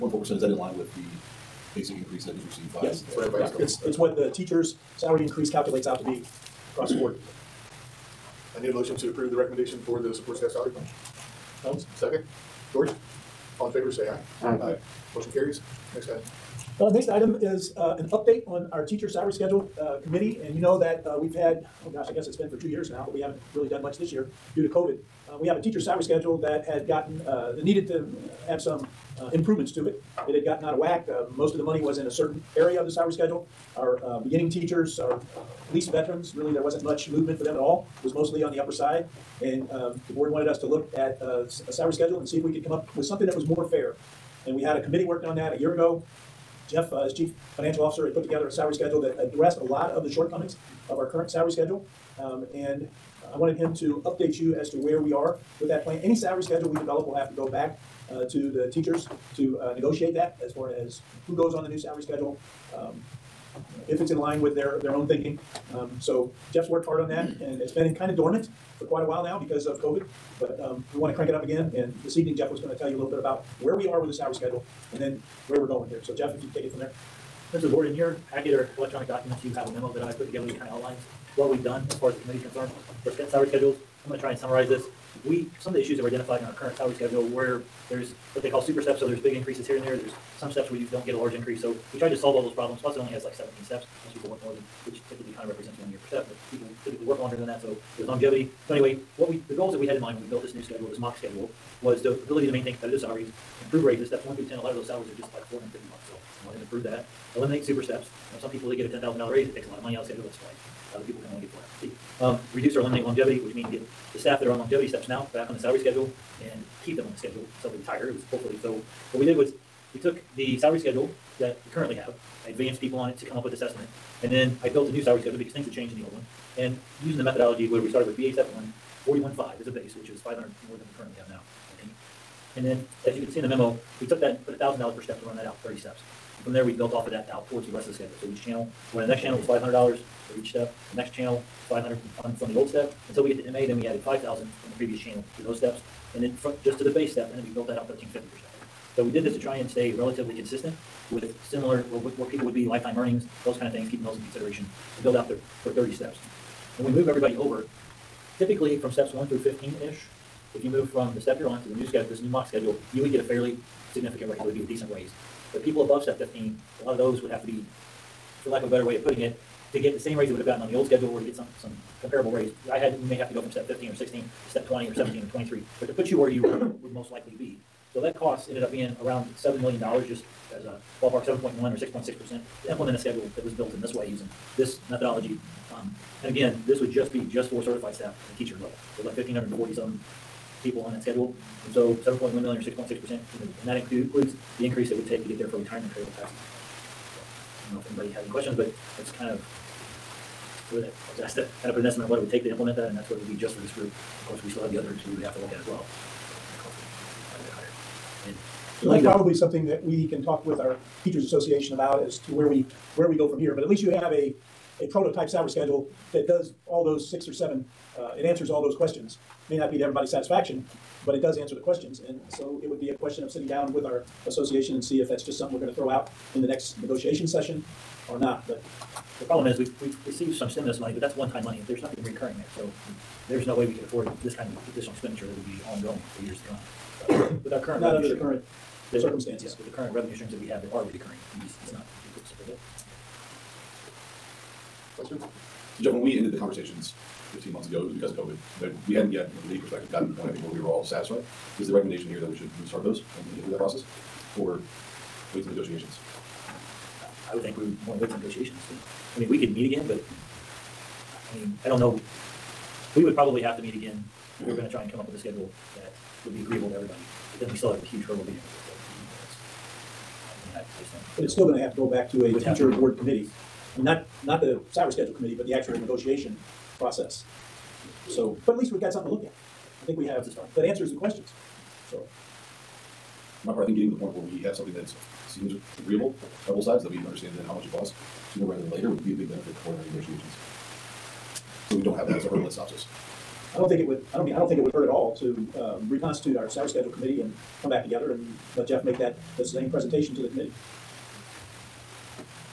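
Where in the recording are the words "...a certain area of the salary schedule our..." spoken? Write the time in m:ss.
0:32.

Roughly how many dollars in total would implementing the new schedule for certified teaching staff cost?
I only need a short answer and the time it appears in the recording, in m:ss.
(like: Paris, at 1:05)
$7 million, at 2:59.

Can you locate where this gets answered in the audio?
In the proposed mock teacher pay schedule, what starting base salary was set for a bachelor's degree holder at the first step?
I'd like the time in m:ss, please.
2:09.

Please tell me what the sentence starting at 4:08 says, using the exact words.
But we hadn't yet, from any perspective, gotten to the point, I think, where we were all satisfied.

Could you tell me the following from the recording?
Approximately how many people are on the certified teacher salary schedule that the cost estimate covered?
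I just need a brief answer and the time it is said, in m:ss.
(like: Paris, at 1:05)
1,540, at 3:09.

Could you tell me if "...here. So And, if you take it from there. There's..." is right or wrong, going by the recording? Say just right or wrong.
wrong.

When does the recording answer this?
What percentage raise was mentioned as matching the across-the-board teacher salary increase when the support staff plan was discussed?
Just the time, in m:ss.
0:00.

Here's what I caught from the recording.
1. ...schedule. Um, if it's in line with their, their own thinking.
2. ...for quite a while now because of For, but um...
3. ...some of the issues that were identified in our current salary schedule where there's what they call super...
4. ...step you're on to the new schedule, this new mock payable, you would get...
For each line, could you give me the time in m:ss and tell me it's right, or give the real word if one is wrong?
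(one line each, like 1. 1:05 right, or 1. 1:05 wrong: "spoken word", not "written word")
1. 1:02 right
2. 1:08 wrong: "COVID", not "For"
3. 1:25 right
4. 2:41 wrong: "schedule", not "payable".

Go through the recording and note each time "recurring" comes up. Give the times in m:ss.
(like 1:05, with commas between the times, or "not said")
3:52, 4:00.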